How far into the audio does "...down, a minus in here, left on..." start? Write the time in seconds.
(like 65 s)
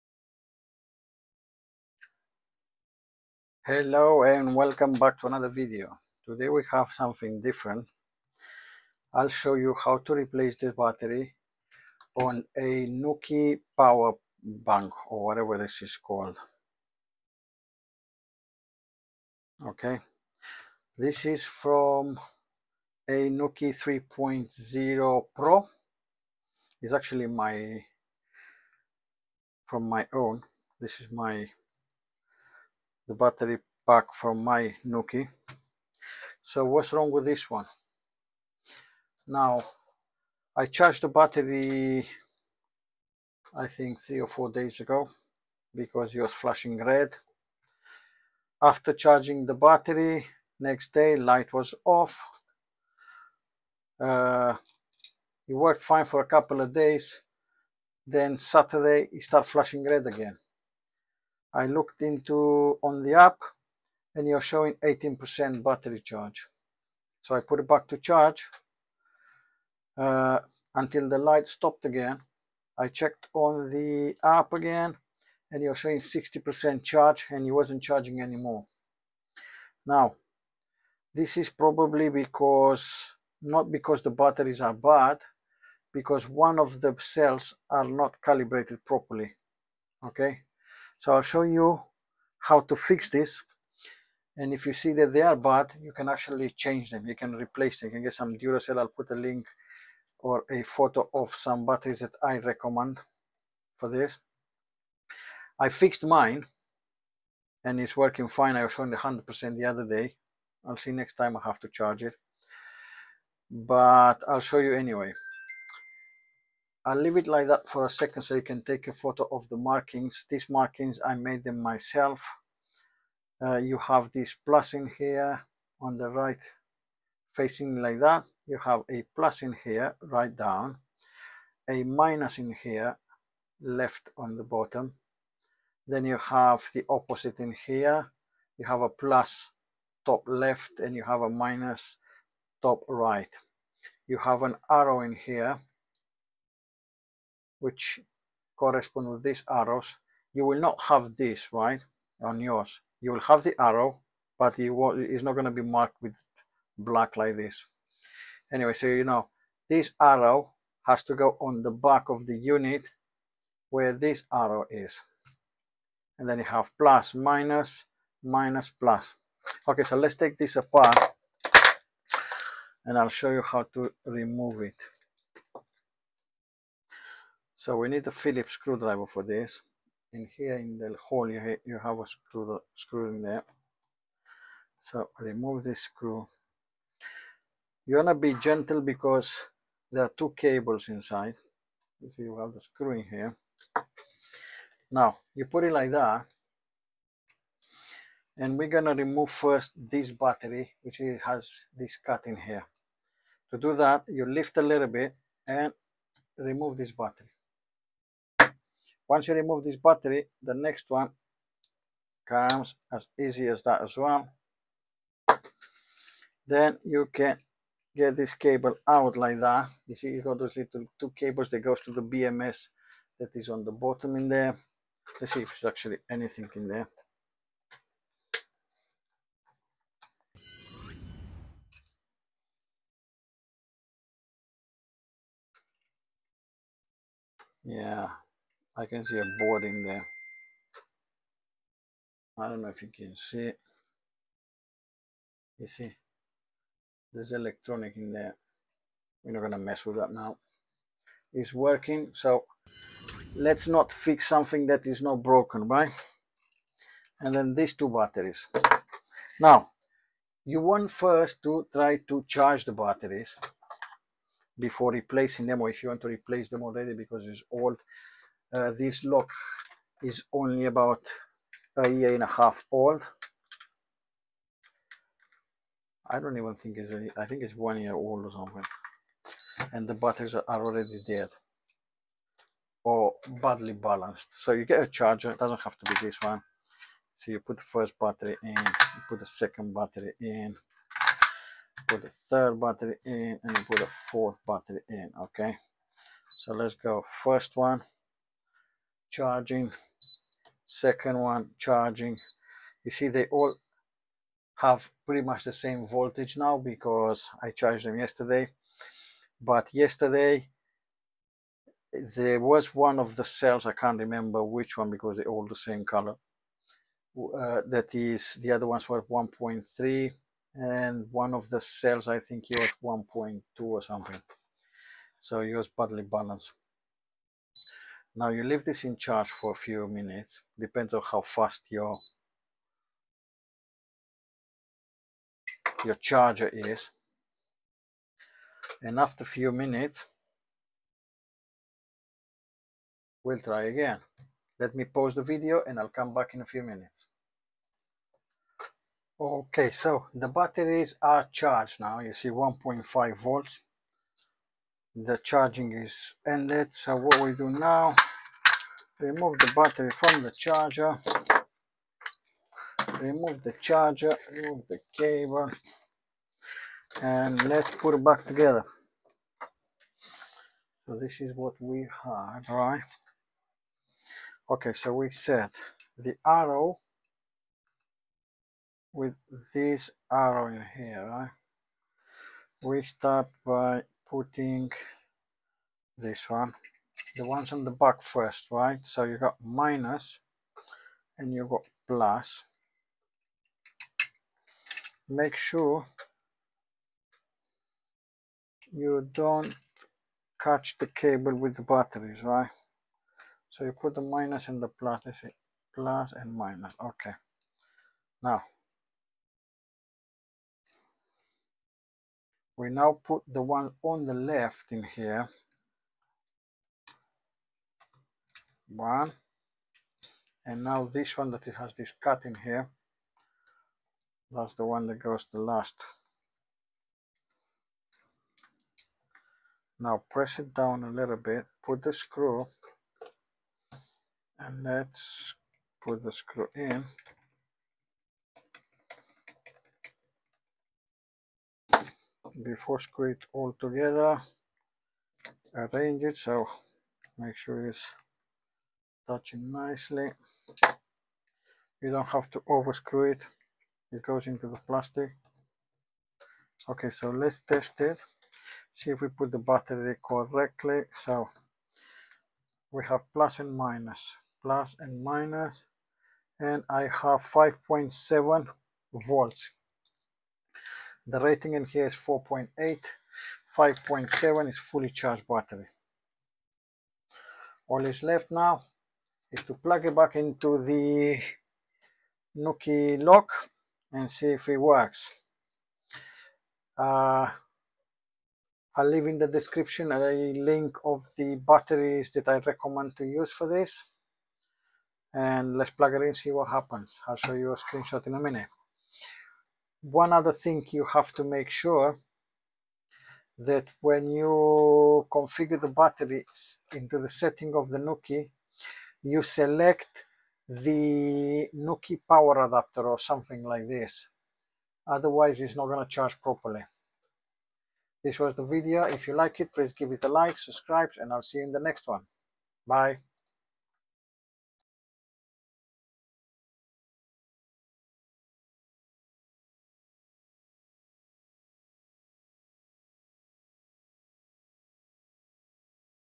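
130 s.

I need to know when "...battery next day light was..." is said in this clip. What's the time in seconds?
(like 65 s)
49 s.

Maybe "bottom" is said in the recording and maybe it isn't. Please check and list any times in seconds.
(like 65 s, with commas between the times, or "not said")
134 s, 223 s.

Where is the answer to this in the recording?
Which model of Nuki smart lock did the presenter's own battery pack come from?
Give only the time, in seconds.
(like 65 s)
23 s.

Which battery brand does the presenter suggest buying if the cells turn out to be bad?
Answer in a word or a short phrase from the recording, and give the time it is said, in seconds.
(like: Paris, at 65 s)
Duracell, at 98 s.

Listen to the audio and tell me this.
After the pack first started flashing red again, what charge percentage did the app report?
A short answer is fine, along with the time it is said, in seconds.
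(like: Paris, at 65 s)
18%, at 64 s.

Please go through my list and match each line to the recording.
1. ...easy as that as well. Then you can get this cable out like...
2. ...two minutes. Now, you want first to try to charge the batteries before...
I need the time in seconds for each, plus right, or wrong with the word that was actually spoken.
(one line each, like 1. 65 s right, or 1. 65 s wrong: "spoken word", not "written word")
1. 213 s right
2. 257 s wrong: "batteries", not "minutes".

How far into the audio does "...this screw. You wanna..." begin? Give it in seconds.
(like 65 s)
185 s.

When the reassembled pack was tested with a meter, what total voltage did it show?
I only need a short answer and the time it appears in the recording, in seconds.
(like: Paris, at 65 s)
5.7 volts, at 467 s.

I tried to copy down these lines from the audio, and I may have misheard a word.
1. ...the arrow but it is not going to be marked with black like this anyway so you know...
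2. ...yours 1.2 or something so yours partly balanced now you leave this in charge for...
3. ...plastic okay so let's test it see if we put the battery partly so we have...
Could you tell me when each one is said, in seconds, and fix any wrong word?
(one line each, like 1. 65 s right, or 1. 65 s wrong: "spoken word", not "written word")
1. 153 s right
2. 322 s right
3. 454 s wrong: "correctly", not "partly".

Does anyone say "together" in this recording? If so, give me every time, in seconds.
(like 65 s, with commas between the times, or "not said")
368 s, 443 s.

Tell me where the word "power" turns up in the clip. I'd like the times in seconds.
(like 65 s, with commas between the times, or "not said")
13 s, 512 s.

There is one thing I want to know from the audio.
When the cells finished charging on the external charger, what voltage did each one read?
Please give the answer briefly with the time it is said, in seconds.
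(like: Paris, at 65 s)
1.5 volts, at 352 s.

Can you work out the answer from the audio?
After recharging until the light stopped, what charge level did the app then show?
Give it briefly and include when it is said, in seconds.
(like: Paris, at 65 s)
60%, at 75 s.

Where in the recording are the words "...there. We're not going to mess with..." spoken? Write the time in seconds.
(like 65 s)
248 s.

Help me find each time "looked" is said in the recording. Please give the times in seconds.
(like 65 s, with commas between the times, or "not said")
61 s.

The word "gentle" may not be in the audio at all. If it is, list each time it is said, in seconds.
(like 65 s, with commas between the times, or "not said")
188 s.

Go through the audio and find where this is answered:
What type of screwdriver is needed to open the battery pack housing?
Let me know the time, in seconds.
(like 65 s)
178 s.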